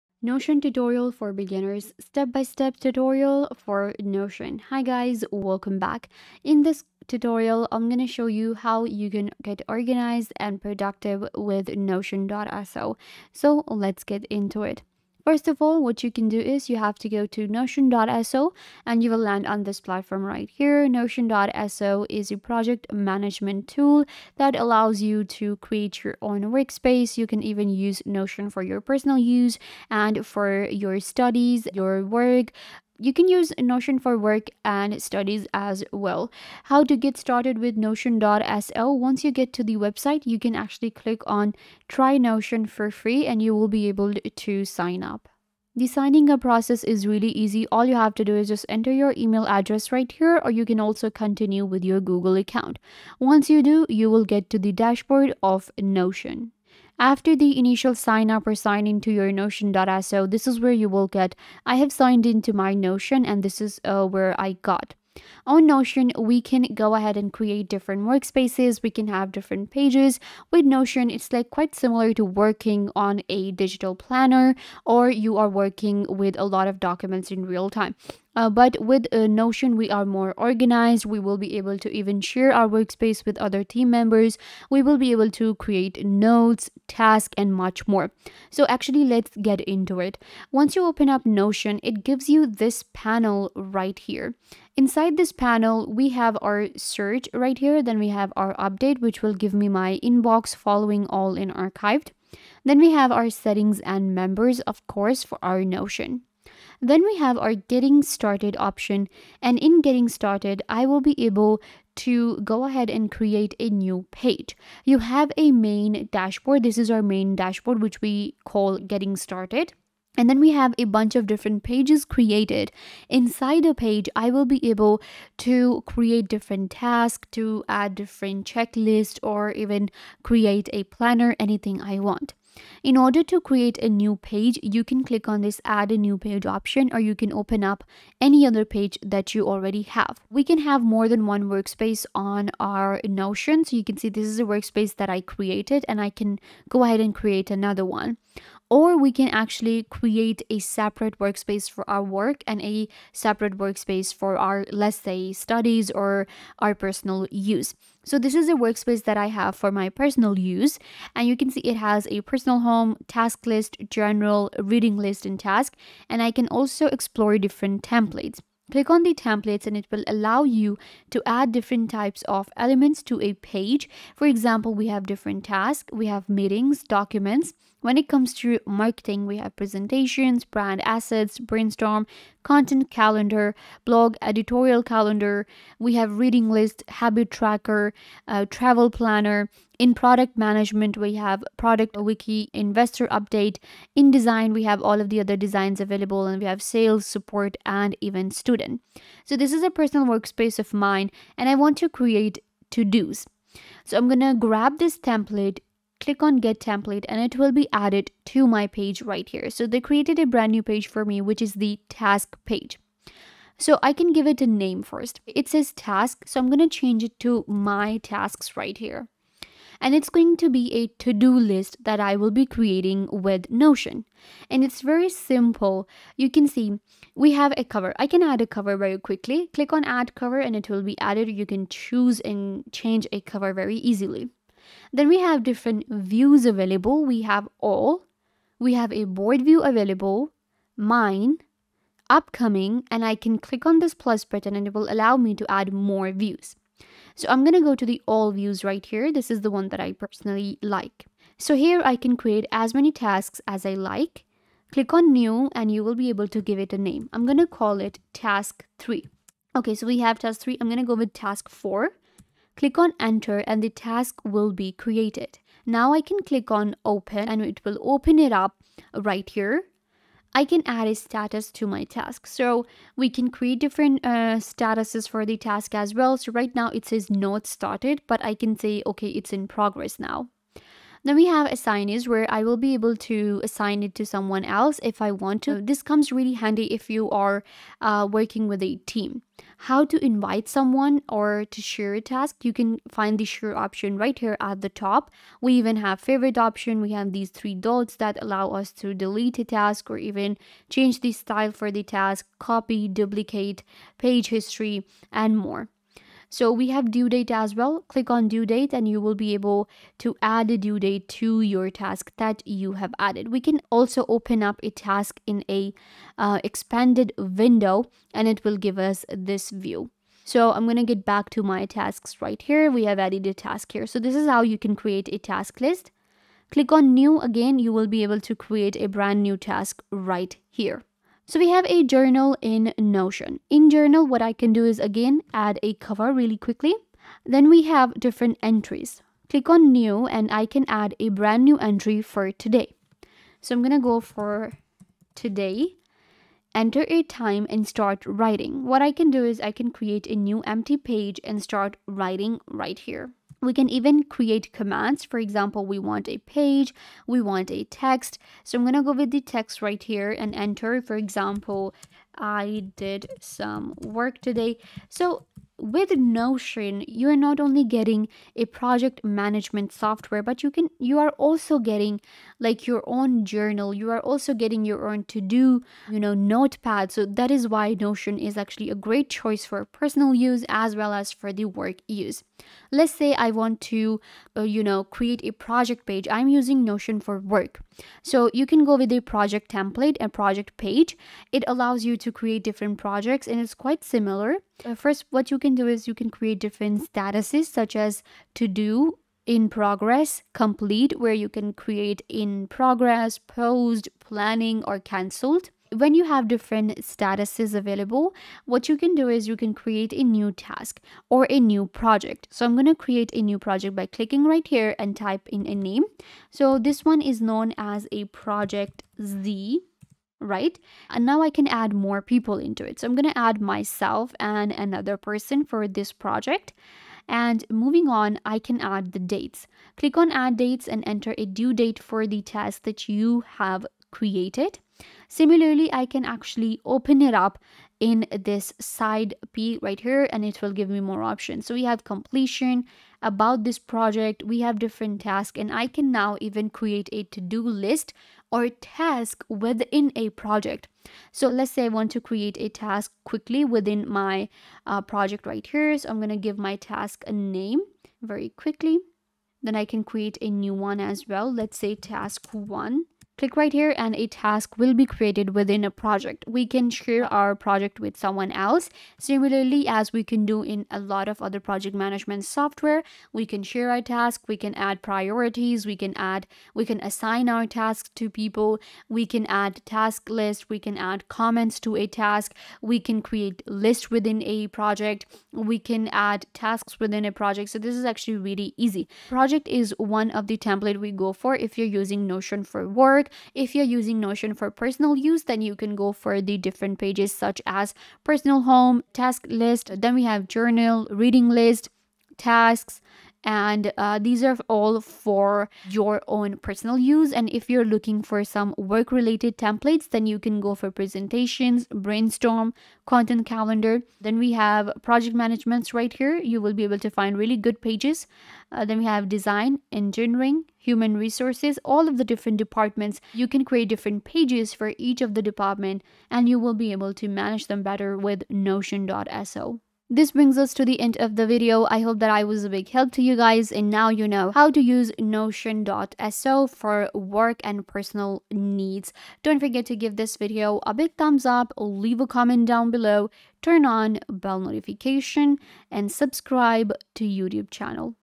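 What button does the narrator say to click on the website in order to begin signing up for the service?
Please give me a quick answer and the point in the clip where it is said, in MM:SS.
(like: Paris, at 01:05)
Try Notion for free, at 00:41.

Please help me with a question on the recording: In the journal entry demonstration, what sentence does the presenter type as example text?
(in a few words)
I did some work today.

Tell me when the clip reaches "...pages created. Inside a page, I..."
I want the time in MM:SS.
02:01.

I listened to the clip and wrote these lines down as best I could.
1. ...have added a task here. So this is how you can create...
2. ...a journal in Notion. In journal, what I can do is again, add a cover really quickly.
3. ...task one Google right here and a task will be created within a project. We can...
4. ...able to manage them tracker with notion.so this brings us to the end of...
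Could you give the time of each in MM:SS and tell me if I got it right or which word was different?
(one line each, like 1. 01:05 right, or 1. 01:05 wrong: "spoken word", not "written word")
1. 05:22 right
2. 05:31 right
3. 07:41 wrong: "Click", not "Google"
4. 08:46 wrong: "better", not "tracker".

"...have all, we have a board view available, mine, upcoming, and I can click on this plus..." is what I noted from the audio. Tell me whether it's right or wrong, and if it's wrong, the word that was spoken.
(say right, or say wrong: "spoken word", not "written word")
right.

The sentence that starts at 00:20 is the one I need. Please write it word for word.
Notion.so is a project management tool that allows you to create your own workspace.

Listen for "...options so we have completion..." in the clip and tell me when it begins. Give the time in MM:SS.
07:21.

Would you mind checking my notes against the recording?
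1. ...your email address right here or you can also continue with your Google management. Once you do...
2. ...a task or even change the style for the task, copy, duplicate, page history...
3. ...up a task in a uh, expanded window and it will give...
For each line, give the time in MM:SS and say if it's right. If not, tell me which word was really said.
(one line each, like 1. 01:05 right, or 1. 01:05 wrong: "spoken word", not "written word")
1. 00:48 wrong: "account", not "management"
2. 04:59 right
3. 05:14 right.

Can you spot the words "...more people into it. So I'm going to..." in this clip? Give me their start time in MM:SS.
07:01.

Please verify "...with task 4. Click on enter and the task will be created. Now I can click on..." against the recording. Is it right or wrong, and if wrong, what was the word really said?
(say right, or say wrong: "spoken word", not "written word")
right.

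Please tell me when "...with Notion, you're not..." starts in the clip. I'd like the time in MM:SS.
06:05.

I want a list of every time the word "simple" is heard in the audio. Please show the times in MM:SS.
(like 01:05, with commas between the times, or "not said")
03:45.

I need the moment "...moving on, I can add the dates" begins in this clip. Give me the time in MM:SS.
07:07.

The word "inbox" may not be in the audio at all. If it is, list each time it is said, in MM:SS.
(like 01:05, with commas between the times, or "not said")
01:40.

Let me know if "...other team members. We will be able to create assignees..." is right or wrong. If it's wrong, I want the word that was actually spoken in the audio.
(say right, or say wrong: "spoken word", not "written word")
wrong: "notes", not "assignees".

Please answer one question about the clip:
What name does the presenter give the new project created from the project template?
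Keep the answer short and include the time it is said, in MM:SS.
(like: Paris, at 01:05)
Project Z, at 06:58.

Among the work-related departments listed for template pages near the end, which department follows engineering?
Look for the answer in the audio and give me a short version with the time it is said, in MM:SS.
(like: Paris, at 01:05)
Human resources, at 08:40.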